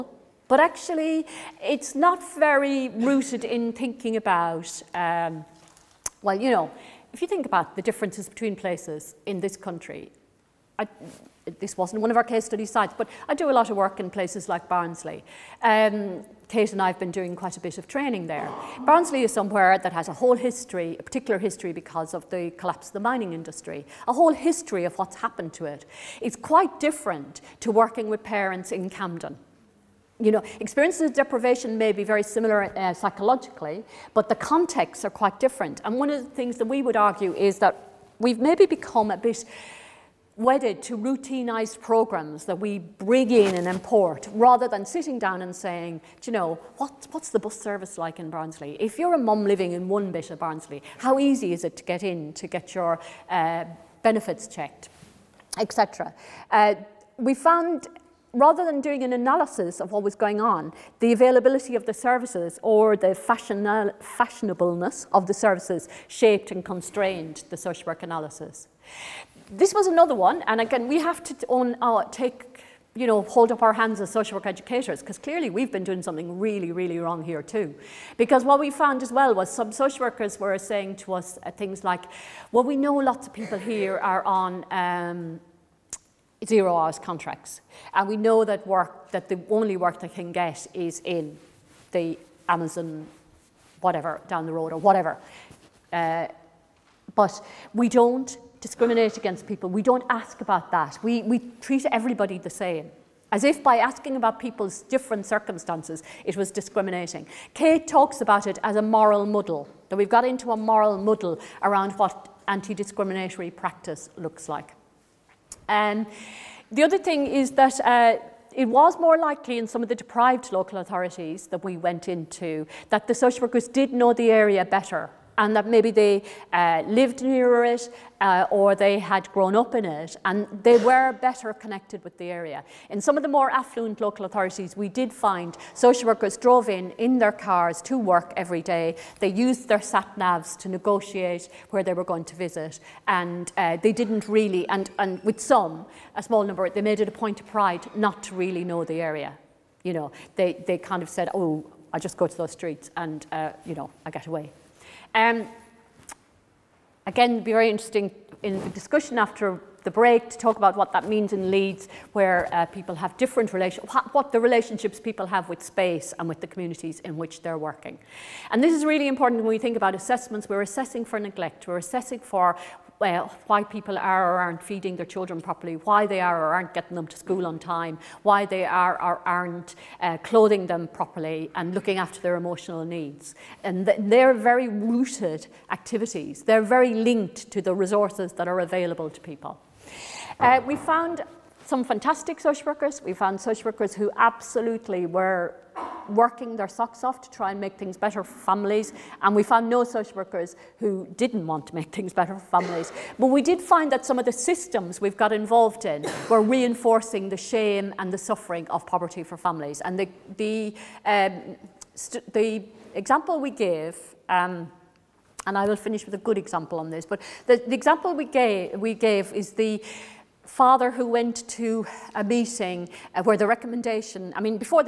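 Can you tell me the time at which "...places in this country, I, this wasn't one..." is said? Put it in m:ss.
0:08.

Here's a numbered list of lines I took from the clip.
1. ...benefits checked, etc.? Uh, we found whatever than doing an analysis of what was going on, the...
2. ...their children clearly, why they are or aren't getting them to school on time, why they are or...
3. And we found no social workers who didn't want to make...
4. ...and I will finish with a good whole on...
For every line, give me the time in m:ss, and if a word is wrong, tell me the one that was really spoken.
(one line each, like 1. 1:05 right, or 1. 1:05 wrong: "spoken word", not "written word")
1. 0:54 wrong: "rather", not "whatever"
2. 2:54 wrong: "properly", not "clearly"
3. 3:19 right
4. 3:35 wrong: "example", not "whole".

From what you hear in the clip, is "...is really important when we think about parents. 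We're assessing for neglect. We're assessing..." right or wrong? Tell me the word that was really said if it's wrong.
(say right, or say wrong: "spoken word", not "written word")
wrong: "assessments", not "parents".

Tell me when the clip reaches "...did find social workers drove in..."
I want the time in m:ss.
2:14.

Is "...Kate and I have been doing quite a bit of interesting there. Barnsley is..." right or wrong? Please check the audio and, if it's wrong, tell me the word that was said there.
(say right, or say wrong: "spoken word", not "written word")
wrong: "training", not "interesting".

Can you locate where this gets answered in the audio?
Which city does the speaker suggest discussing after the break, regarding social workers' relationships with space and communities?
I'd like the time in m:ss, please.
2:41.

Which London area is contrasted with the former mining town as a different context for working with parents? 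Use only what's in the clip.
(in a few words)
Camden.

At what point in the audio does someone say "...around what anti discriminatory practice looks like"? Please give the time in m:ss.
1:51.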